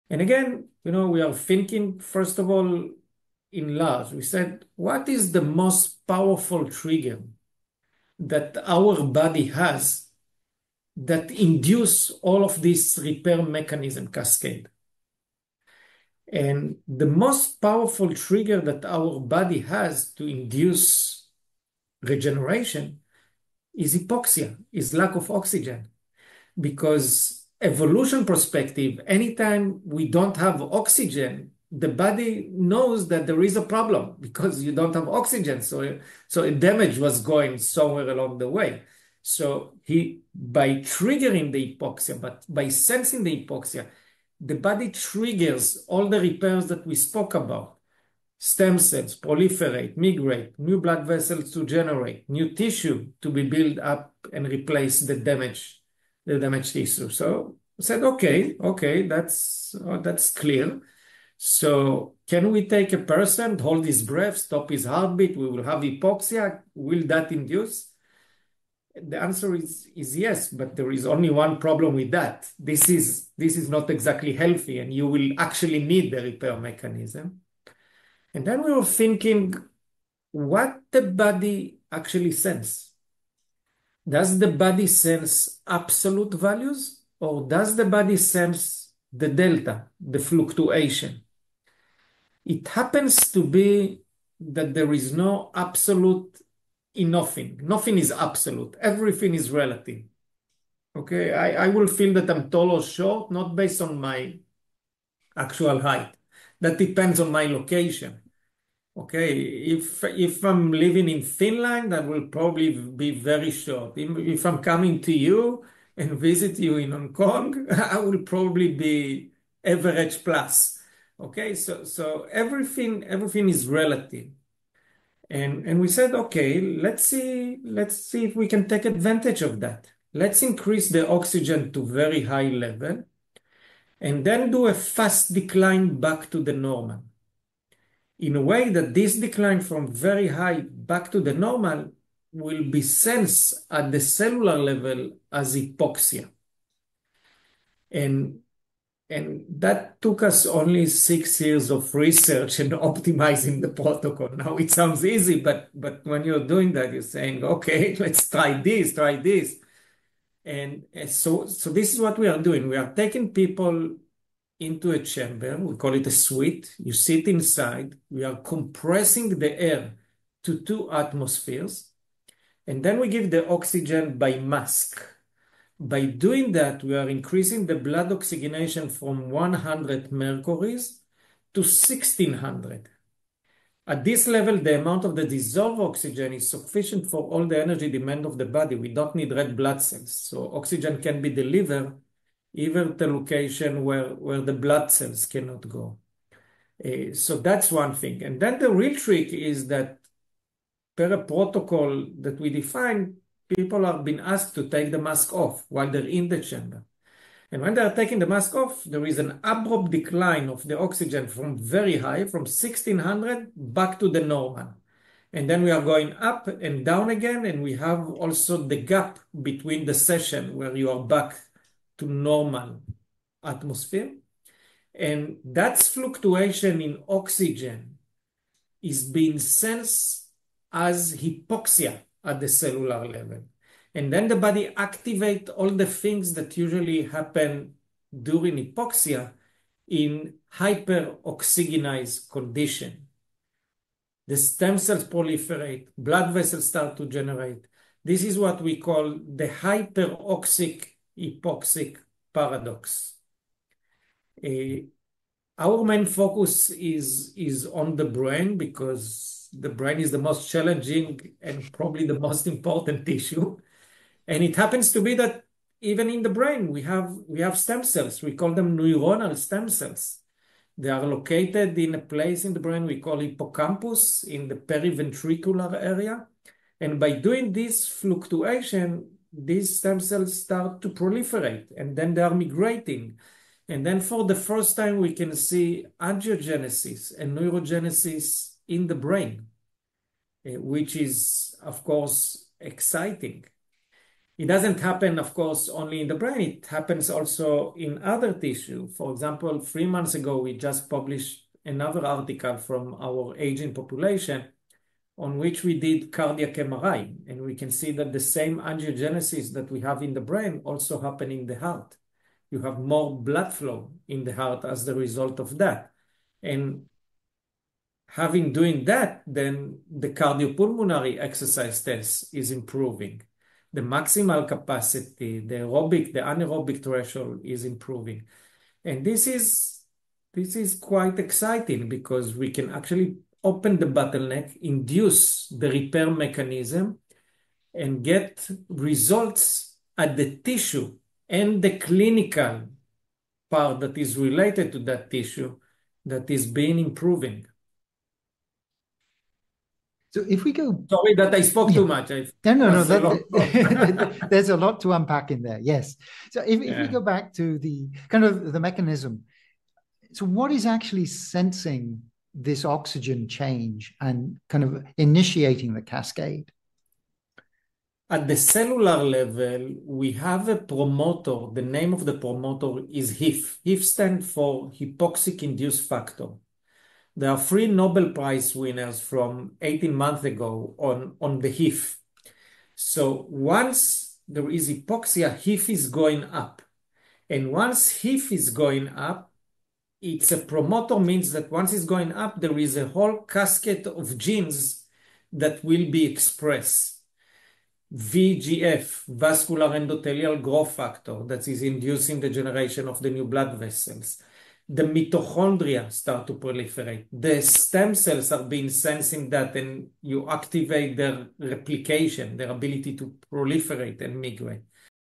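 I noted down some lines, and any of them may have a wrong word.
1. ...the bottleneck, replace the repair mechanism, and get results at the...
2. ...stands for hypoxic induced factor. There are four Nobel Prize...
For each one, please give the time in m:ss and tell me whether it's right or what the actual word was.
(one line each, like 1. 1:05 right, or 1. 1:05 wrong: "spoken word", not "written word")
1. 5:33 wrong: "induce", not "replace"
2. 6:13 wrong: "three", not "four".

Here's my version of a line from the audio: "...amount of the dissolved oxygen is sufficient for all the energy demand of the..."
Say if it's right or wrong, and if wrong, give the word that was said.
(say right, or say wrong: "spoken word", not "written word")
right.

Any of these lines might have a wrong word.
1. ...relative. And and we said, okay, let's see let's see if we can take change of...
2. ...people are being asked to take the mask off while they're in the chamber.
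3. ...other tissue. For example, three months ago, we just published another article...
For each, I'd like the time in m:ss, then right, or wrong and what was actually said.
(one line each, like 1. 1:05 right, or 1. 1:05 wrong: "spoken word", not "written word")
1. 2:03 wrong: "advantage", not "change"
2. 3:23 right
3. 4:58 right.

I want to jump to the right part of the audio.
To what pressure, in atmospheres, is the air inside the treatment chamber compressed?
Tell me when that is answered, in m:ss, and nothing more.
2:50.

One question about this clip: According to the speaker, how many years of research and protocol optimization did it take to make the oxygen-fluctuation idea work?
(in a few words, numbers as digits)
6.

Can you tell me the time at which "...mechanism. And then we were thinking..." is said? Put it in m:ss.
1:16.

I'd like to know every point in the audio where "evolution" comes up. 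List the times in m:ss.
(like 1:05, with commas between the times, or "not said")
0:27.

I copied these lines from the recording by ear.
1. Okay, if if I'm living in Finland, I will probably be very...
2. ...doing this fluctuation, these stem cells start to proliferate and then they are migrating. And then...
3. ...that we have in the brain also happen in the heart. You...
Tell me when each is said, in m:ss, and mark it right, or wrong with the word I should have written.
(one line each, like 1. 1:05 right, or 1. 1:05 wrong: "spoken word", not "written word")
1. 1:48 right
2. 4:37 right
3. 5:09 right.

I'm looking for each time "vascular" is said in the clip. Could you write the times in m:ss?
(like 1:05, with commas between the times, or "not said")
6:39.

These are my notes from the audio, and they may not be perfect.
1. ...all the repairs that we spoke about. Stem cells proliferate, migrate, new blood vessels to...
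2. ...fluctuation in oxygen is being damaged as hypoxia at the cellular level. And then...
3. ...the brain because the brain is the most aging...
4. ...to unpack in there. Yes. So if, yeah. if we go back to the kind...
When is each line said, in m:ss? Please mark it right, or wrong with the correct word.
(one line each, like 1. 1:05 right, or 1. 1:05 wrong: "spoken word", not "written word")
1. 0:45 right
2. 3:45 wrong: "sensed", not "damaged"
3. 4:17 wrong: "challenging", not "aging"
4. 5:54 right.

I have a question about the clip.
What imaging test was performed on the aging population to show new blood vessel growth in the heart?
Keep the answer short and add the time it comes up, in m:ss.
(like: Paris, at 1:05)
Cardiac MRI, at 5:06.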